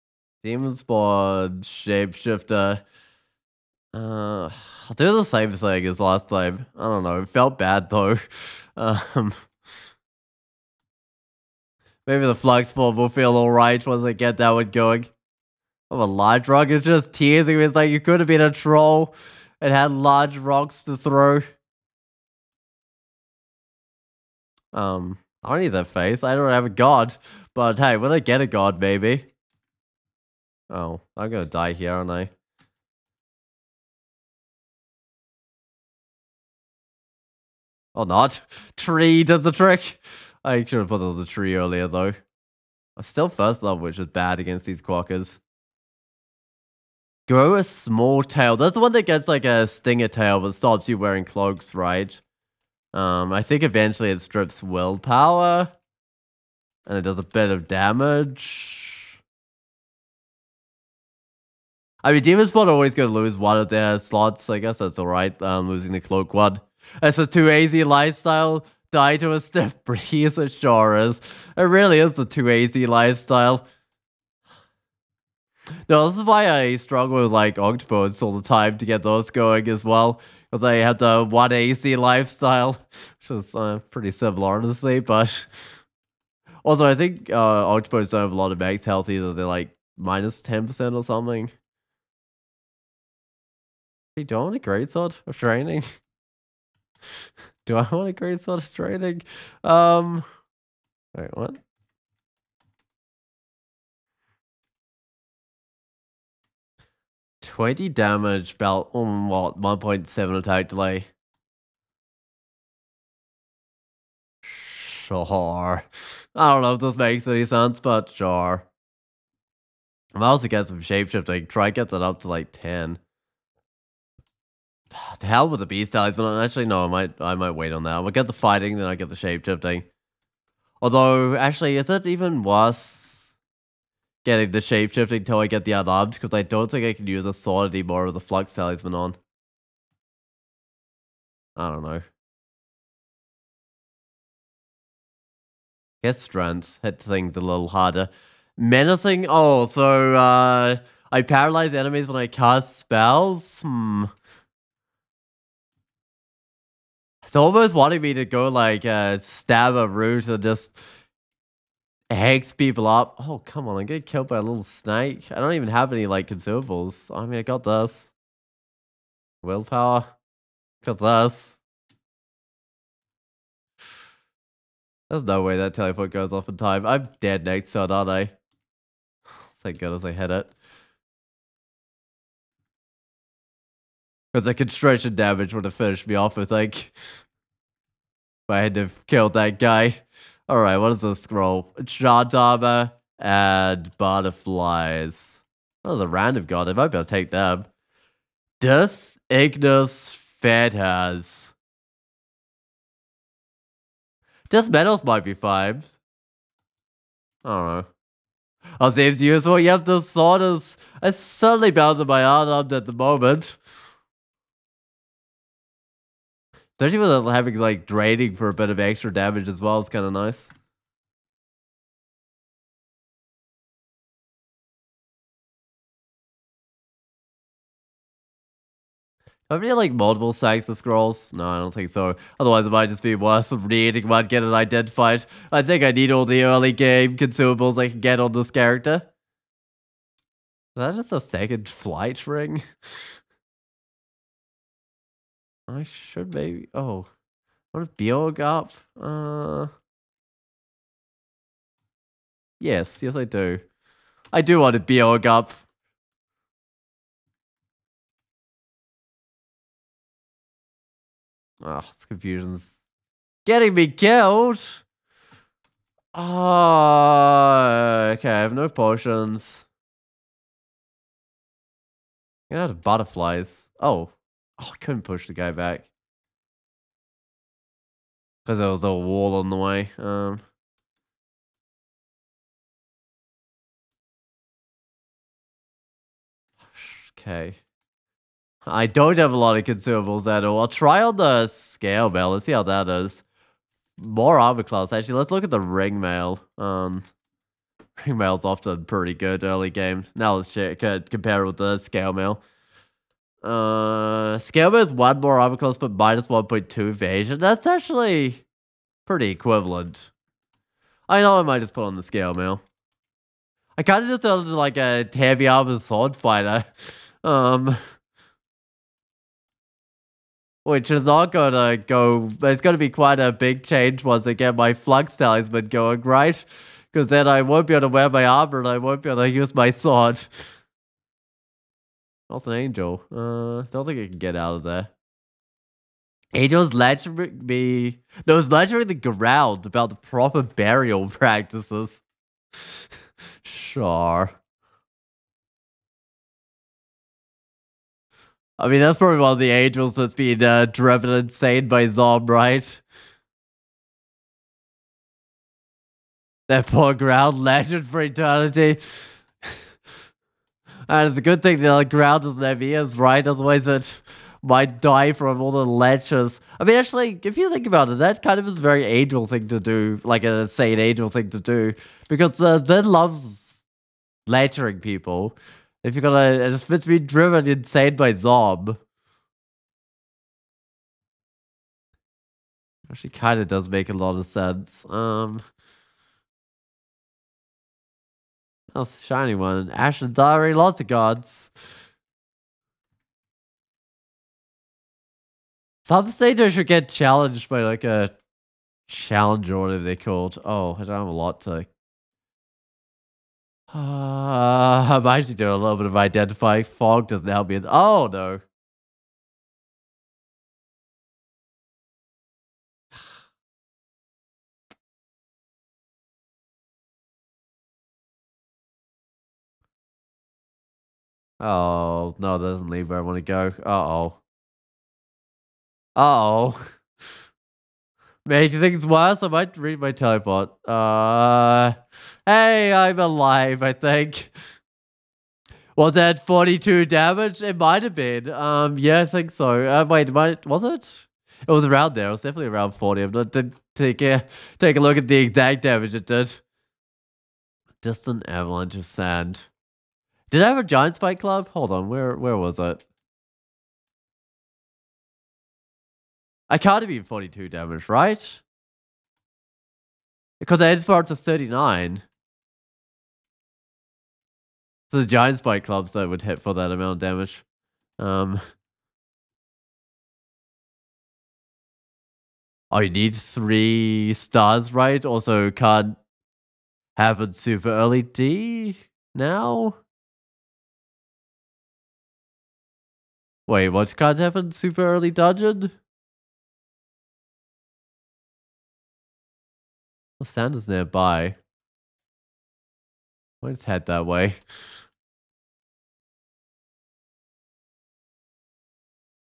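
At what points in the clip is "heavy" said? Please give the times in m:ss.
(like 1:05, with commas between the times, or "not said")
5:15, 6:02.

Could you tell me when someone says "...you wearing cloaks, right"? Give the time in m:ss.
0:50.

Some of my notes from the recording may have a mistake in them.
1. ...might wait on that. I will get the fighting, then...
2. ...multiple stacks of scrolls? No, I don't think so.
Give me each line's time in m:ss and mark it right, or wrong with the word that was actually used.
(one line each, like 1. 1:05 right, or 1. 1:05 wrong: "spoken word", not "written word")
1. 2:07 right
2. 3:49 right.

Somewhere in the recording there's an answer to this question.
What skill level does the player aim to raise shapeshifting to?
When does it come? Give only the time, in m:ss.
2:02.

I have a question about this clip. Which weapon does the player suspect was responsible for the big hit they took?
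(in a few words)
giant spiked club.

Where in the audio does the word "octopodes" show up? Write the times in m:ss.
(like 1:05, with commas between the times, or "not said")
1:17, 1:27.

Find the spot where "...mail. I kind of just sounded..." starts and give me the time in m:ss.
5:12.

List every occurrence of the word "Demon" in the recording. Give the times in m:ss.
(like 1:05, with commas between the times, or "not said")
0:00, 1:02.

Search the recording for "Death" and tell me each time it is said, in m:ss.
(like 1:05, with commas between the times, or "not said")
3:18, 3:24.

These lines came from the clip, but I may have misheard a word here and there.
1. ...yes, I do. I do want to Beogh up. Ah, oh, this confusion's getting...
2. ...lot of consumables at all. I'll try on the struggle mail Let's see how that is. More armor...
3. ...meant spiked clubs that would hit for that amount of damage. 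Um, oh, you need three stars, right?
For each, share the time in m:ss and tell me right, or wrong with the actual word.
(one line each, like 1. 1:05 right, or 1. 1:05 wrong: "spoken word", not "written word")
1. 4:13 right
2. 4:49 wrong: "scale", not "struggle"
3. 7:45 wrong: "giant", not "meant".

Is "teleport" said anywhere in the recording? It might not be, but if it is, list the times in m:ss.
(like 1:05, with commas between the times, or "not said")
2:55, 7:09.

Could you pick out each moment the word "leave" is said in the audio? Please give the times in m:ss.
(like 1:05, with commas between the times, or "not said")
7:02.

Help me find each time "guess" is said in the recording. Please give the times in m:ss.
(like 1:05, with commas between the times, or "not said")
1:04.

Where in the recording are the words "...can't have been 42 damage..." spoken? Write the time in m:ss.
7:36.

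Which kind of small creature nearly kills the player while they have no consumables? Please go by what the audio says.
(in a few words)
a little snake.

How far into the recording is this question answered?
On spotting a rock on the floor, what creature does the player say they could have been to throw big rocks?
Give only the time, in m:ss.
0:18.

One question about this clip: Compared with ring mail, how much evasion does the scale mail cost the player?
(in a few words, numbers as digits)
1.2.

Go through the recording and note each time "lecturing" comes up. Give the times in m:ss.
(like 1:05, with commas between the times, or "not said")
6:14.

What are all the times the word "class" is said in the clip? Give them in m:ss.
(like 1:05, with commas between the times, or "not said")
4:54, 5:05.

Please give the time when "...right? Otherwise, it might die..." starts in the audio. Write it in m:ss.
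6:02.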